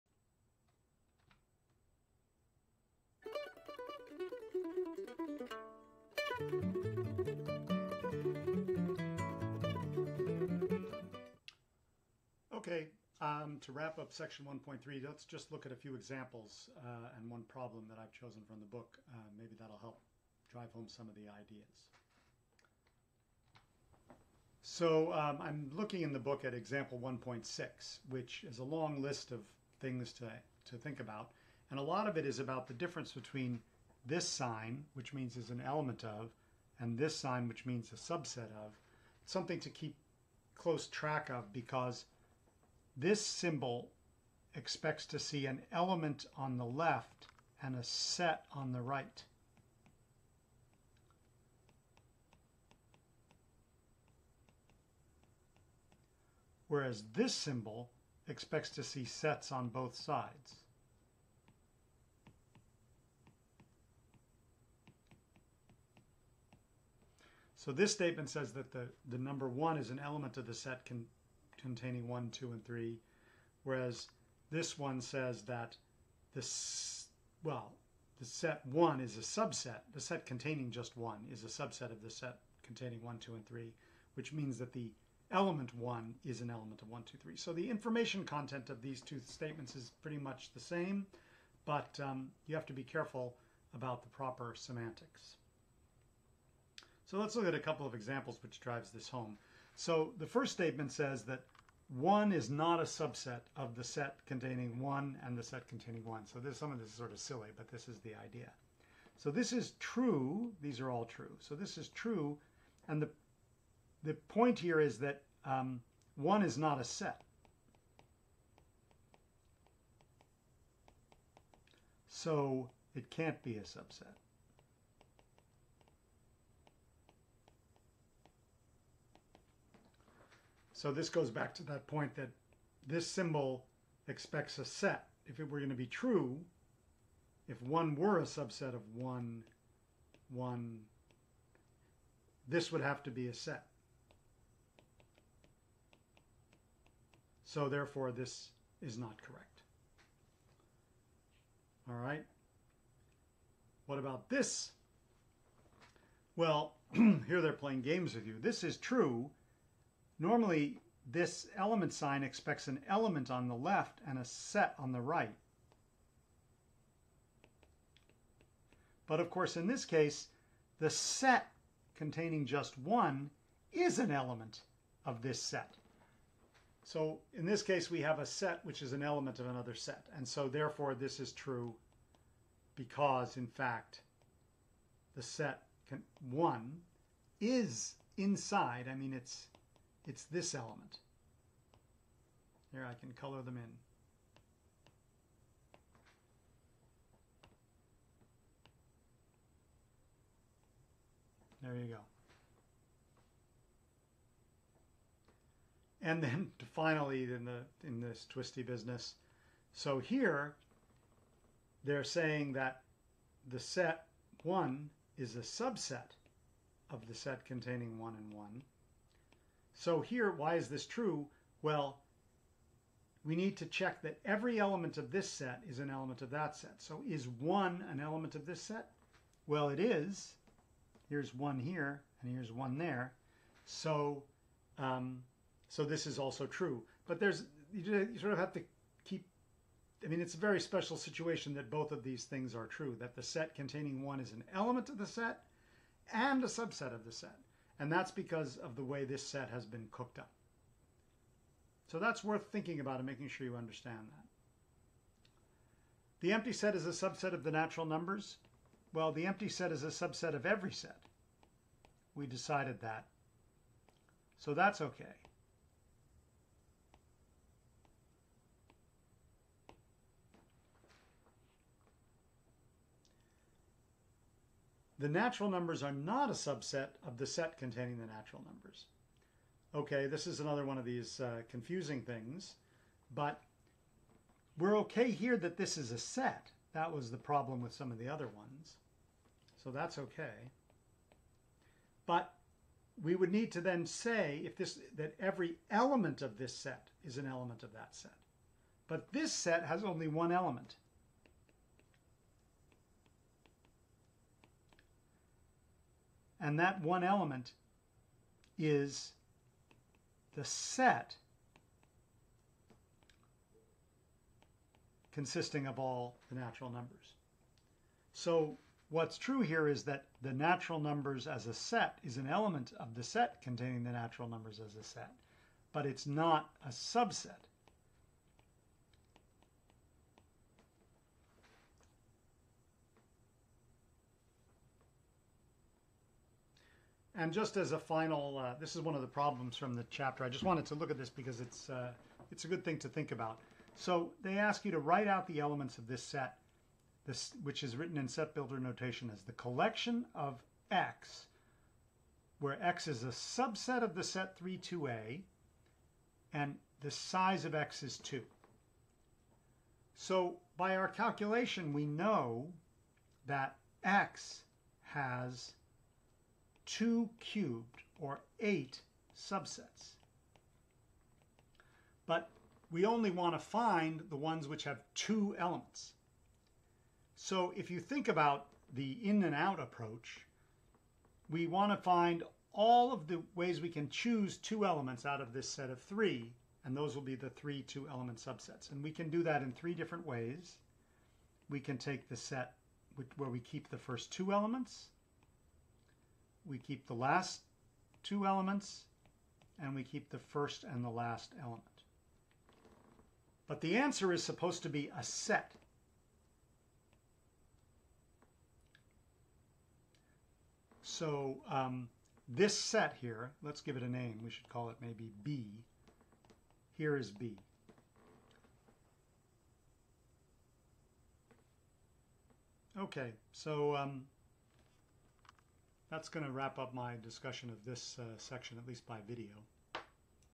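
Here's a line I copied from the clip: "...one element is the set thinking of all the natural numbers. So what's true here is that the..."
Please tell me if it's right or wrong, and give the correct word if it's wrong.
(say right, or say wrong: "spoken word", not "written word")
wrong: "consisting", not "thinking".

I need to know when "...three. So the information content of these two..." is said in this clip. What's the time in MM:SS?
01:27.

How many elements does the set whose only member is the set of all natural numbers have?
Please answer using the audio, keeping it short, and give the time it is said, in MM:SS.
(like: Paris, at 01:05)
1, at 04:59.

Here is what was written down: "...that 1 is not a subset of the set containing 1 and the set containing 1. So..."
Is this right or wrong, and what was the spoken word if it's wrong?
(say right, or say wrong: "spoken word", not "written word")
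right.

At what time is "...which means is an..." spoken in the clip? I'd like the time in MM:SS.
00:34.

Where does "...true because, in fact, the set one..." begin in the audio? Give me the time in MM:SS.
03:01.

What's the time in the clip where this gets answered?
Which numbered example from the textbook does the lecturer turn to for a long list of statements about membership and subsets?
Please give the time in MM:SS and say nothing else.
00:26.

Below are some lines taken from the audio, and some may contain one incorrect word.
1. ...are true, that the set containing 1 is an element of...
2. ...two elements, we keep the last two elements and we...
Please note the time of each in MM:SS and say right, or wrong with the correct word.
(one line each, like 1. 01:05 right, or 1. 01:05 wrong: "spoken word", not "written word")
1. 04:02 right
2. 06:34 right.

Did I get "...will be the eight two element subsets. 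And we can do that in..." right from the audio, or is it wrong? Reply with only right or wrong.
wrong.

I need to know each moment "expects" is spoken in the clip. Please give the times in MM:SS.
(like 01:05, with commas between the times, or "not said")
00:44, 00:58, 02:14, 02:42.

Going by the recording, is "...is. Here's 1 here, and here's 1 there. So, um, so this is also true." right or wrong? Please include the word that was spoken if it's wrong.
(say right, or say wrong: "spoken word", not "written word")
right.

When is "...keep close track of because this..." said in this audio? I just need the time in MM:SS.
00:39.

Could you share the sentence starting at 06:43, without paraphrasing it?
But the answer is supposed to be a set.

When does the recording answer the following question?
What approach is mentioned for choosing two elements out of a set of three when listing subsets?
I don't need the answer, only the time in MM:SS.
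06:19.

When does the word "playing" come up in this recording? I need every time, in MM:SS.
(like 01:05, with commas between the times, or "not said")
02:37.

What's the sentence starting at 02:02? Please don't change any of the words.
So it can't be a subset.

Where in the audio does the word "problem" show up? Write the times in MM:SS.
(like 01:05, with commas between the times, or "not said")
00:17, 04:47, 05:39.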